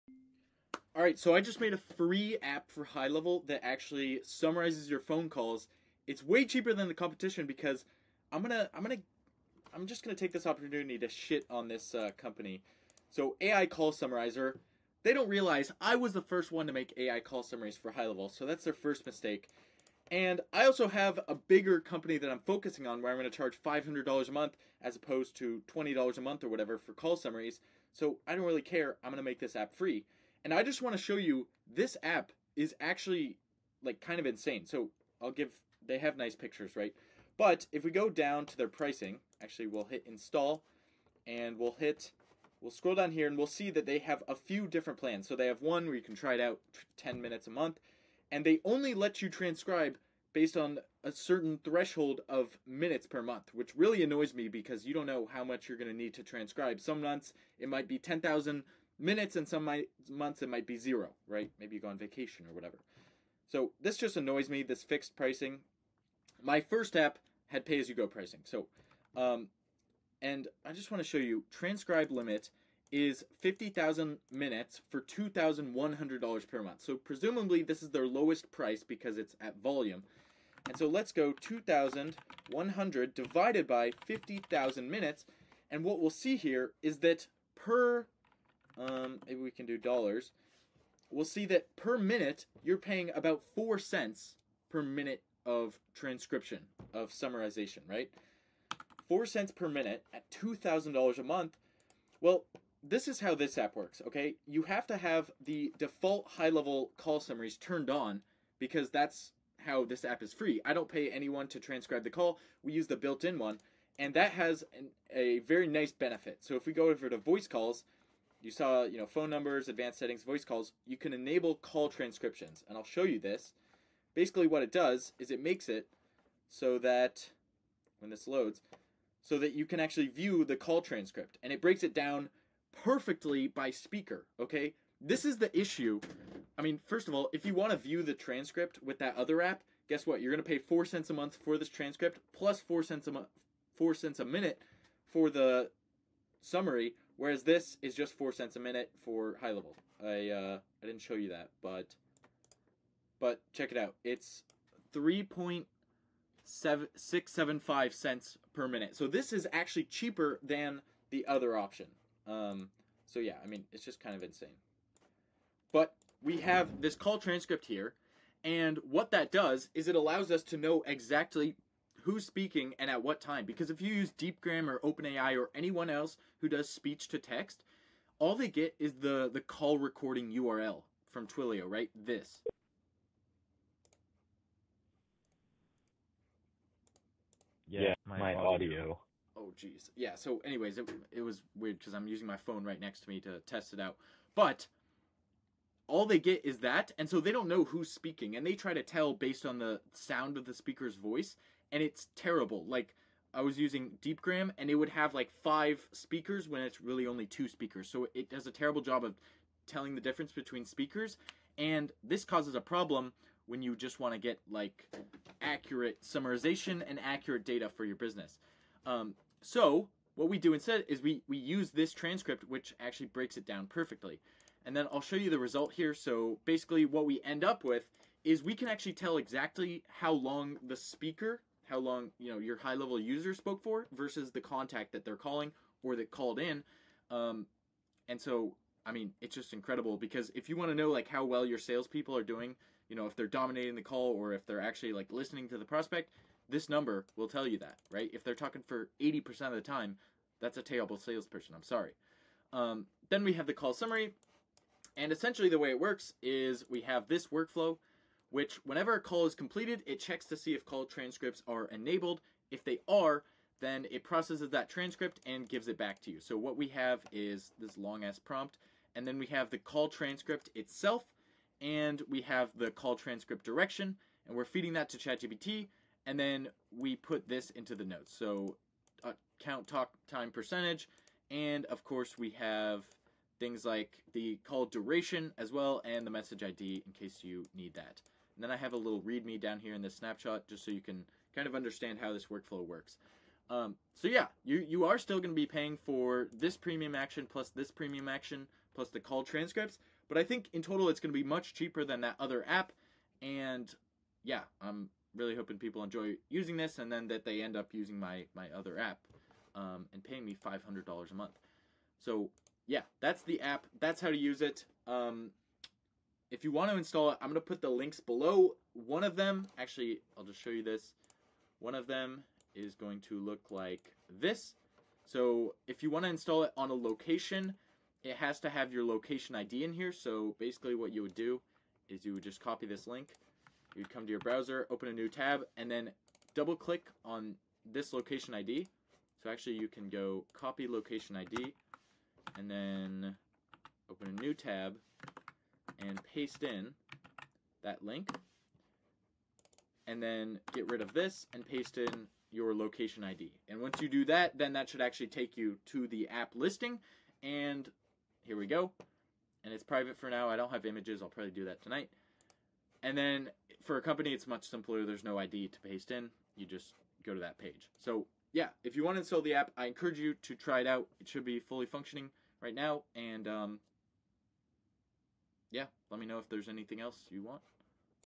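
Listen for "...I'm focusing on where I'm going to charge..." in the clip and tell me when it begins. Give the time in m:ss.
0:22.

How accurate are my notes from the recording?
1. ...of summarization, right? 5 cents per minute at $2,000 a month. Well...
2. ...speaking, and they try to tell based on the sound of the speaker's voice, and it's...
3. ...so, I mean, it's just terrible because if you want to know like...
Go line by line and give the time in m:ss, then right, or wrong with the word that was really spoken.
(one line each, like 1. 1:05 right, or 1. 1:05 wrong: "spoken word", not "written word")
1. 1:36 wrong: "4", not "5"
2. 3:17 right
3. 3:58 wrong: "incredible", not "terrible".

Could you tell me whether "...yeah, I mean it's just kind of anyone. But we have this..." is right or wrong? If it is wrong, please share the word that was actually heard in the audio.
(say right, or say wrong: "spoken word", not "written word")
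wrong: "insane", not "anyone".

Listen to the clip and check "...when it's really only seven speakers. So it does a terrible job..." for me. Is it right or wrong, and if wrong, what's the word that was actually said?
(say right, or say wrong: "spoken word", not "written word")
wrong: "two", not "seven".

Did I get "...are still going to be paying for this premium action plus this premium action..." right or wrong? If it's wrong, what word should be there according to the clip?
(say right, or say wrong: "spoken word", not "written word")
right.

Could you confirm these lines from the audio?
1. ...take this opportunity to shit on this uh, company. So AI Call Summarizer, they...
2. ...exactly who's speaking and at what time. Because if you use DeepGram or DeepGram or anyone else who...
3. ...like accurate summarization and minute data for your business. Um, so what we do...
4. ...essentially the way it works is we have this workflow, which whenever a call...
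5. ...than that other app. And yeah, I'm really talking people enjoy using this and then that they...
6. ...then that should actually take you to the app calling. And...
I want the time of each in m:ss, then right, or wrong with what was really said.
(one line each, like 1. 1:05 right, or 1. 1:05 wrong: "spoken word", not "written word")
1. 0:10 right
2. 2:50 wrong: "OpenAI", not "DeepGram"
3. 3:34 wrong: "accurate", not "minute"
4. 4:15 right
5. 5:01 wrong: "hoping", not "talking"
6. 5:54 wrong: "listing", not "calling".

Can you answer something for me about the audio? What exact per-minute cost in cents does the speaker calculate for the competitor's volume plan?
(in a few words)
3.7675 cents.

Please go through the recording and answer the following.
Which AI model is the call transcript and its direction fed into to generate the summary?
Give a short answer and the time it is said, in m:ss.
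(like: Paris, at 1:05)
ChatGPT, at 4:34.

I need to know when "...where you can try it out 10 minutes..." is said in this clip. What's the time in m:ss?
0:45.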